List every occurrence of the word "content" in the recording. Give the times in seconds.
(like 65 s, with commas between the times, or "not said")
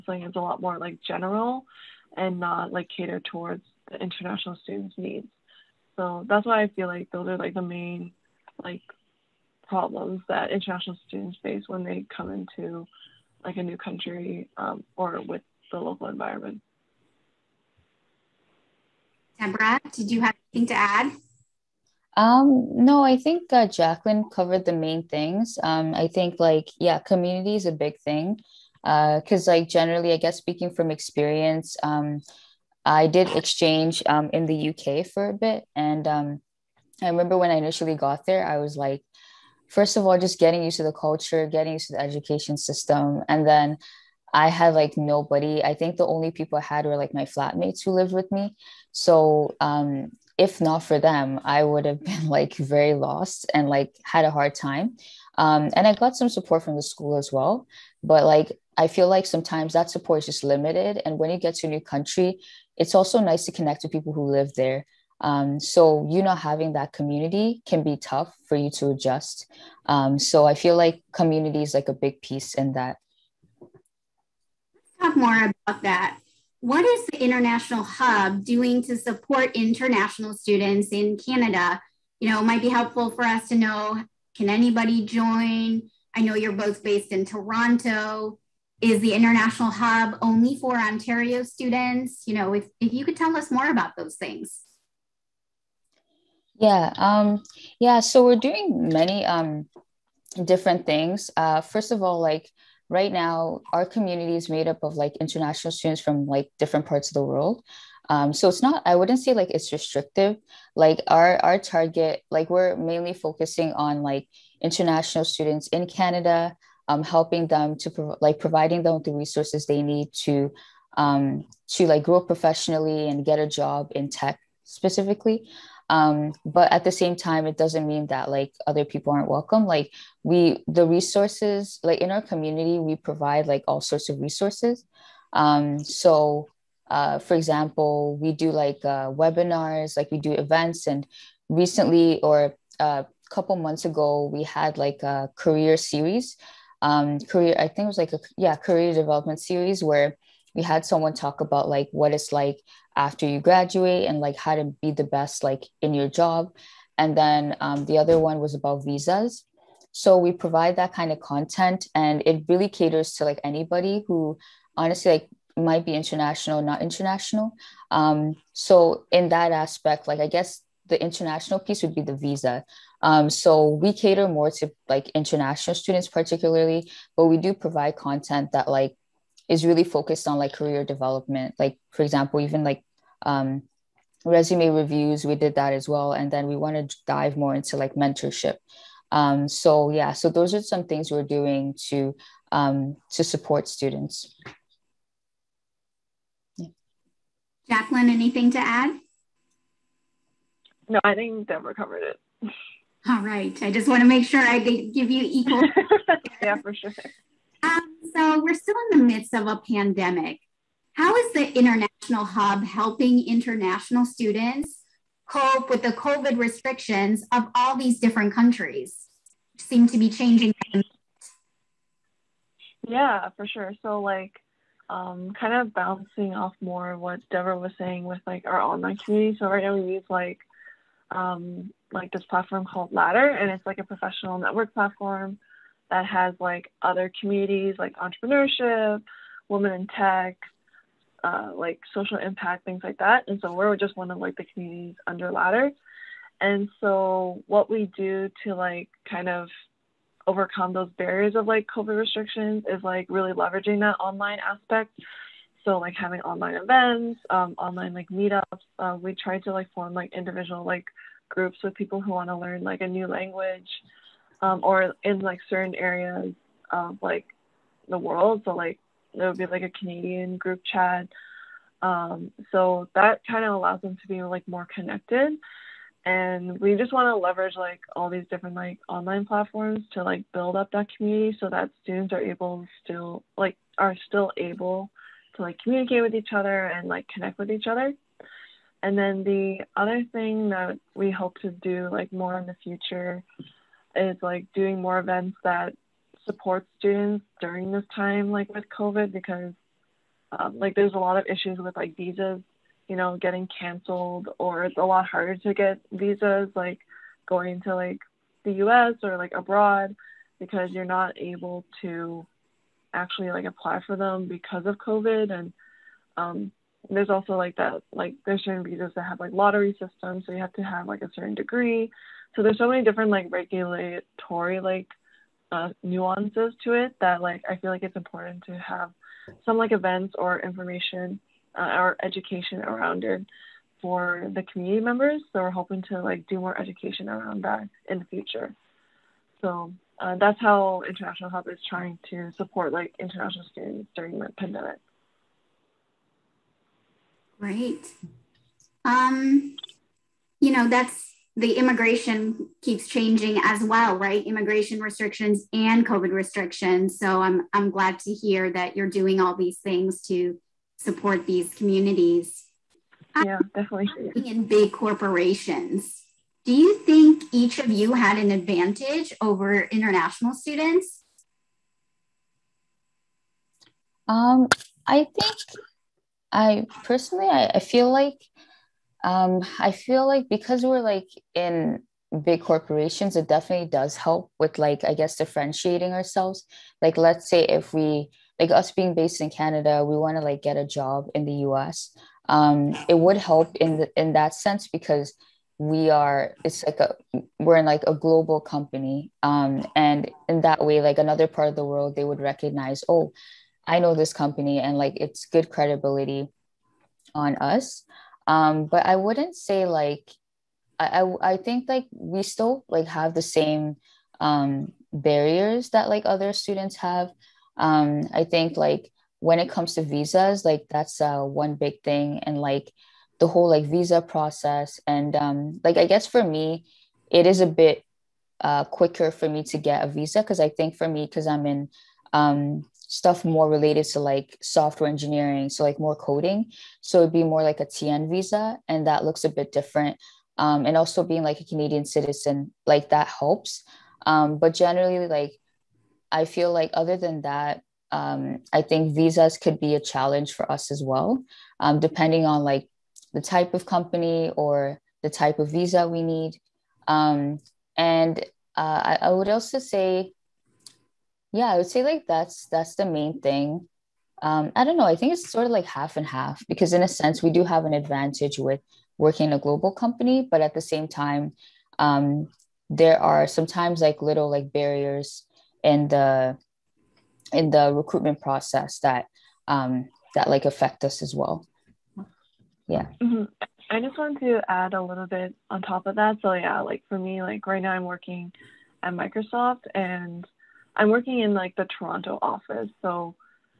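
161 s, 177 s.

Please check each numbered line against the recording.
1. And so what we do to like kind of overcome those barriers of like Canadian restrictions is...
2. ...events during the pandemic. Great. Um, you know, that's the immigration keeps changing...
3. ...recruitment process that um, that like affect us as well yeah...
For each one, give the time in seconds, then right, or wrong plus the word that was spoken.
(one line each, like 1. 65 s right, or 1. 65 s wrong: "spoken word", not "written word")
1. 246 s wrong: "COVID", not "Canadian"
2. 343 s wrong: "students", not "events"
3. 477 s right.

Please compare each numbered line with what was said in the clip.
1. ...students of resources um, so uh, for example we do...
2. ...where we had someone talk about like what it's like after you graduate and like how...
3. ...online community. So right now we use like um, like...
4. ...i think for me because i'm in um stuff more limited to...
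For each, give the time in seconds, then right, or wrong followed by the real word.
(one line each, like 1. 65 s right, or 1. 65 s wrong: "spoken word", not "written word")
1. 133 s wrong: "sorts", not "students"
2. 149 s right
3. 228 s right
4. 430 s wrong: "related", not "limited".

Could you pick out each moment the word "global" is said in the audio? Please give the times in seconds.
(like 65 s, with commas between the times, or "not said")
397 s, 469 s.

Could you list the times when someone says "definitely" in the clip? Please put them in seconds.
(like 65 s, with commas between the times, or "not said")
363 s, 383 s.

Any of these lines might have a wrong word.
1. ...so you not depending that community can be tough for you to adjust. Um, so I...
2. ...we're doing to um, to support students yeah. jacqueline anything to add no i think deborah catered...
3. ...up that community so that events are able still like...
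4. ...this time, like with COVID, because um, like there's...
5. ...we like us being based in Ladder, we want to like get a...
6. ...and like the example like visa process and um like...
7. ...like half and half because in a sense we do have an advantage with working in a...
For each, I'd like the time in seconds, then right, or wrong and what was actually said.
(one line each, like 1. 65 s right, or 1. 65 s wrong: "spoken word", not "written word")
1. 65 s wrong: "having", not "depending"
2. 191 s wrong: "covered", not "catered"
3. 280 s wrong: "students", not "events"
4. 297 s right
5. 387 s wrong: "Canada", not "Ladder"
6. 422 s wrong: "whole", not "example"
7. 465 s right.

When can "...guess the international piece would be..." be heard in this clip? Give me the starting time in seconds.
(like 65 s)
170 s.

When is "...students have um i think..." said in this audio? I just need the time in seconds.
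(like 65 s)
416 s.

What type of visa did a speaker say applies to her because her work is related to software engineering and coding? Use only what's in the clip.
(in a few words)
TN visa.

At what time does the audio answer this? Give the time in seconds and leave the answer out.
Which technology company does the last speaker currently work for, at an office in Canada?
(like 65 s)
488 s.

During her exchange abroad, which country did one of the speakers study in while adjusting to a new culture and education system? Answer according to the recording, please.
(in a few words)
UK.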